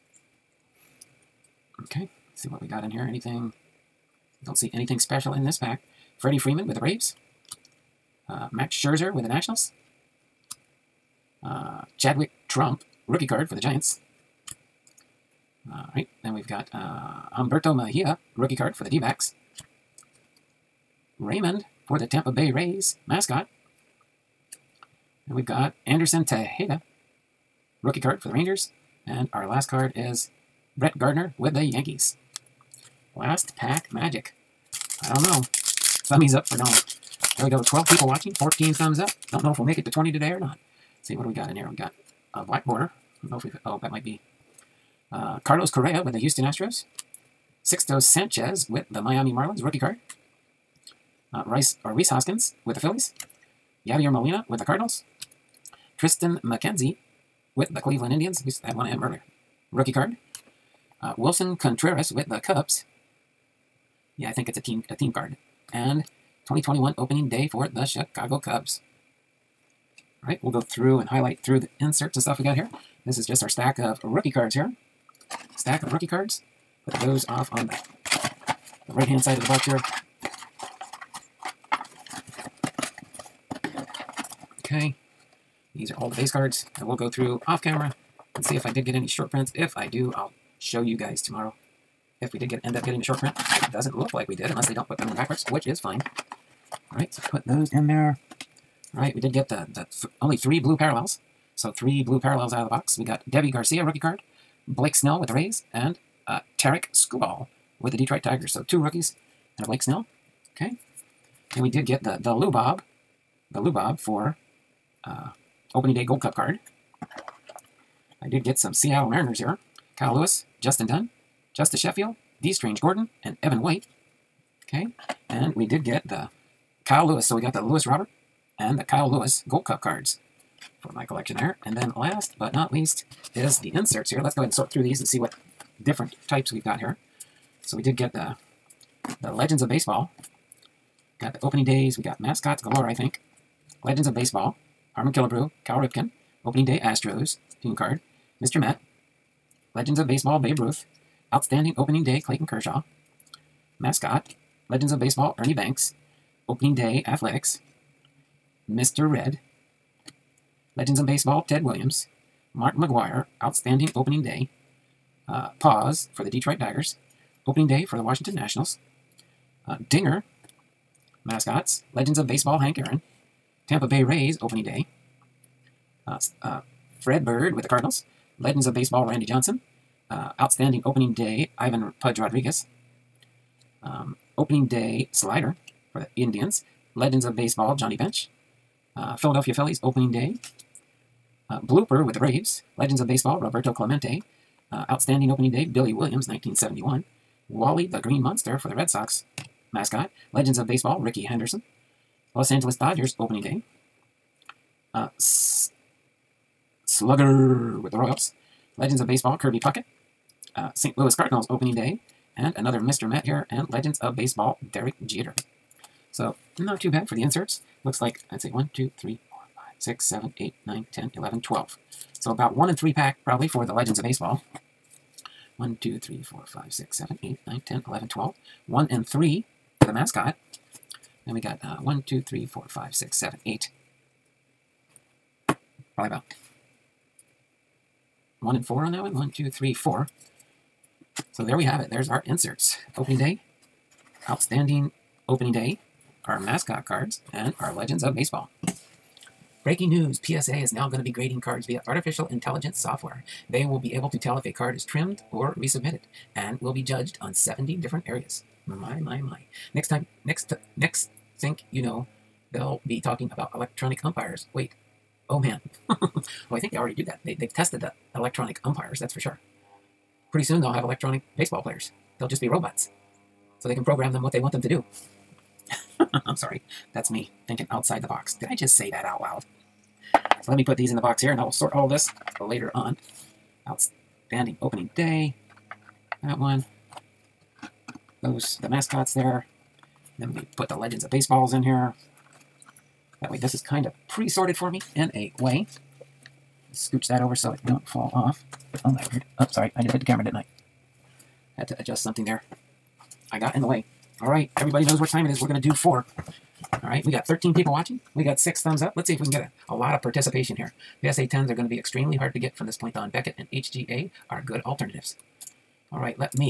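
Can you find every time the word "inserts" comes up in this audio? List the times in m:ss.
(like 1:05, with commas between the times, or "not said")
1:11, 2:13, 3:37, 4:02.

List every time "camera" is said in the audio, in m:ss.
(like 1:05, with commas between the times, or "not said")
1:27, 5:00.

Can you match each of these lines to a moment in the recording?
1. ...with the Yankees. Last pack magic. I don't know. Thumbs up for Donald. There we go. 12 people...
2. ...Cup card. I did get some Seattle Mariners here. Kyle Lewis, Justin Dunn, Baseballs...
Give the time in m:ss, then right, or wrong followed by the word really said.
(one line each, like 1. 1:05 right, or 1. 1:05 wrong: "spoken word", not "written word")
1. 0:31 right
2. 1:56 wrong: "Justus", not "Baseballs".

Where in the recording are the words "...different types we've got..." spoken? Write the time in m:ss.
2:15.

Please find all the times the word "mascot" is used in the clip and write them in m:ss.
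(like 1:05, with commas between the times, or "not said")
0:23, 2:22, 2:33, 2:51, 3:19, 3:49, 4:06, 4:48.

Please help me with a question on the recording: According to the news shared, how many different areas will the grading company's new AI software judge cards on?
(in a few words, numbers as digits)
70.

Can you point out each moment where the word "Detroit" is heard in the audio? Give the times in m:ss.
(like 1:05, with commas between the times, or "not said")
1:47, 2:46.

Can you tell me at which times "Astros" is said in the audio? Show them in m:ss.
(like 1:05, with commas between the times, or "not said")
0:46, 2:26.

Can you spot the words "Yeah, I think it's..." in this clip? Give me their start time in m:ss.
1:04.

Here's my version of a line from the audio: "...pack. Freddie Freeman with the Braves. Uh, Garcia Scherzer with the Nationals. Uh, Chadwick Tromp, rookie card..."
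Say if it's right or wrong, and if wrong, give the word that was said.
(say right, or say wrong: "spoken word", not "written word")
wrong: "Max", not "Garcia".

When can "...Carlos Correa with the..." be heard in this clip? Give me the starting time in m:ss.
0:45.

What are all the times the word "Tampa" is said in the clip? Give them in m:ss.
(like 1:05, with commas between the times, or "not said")
0:22, 2:53.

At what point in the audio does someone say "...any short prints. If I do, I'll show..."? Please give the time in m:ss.
1:28.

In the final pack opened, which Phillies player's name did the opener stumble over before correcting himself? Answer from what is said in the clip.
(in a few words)
Rhys Hoskins.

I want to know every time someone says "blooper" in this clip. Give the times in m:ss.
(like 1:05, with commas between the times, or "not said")
3:11.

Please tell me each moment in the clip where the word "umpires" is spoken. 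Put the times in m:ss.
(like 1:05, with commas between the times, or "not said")
4:24, 4:28.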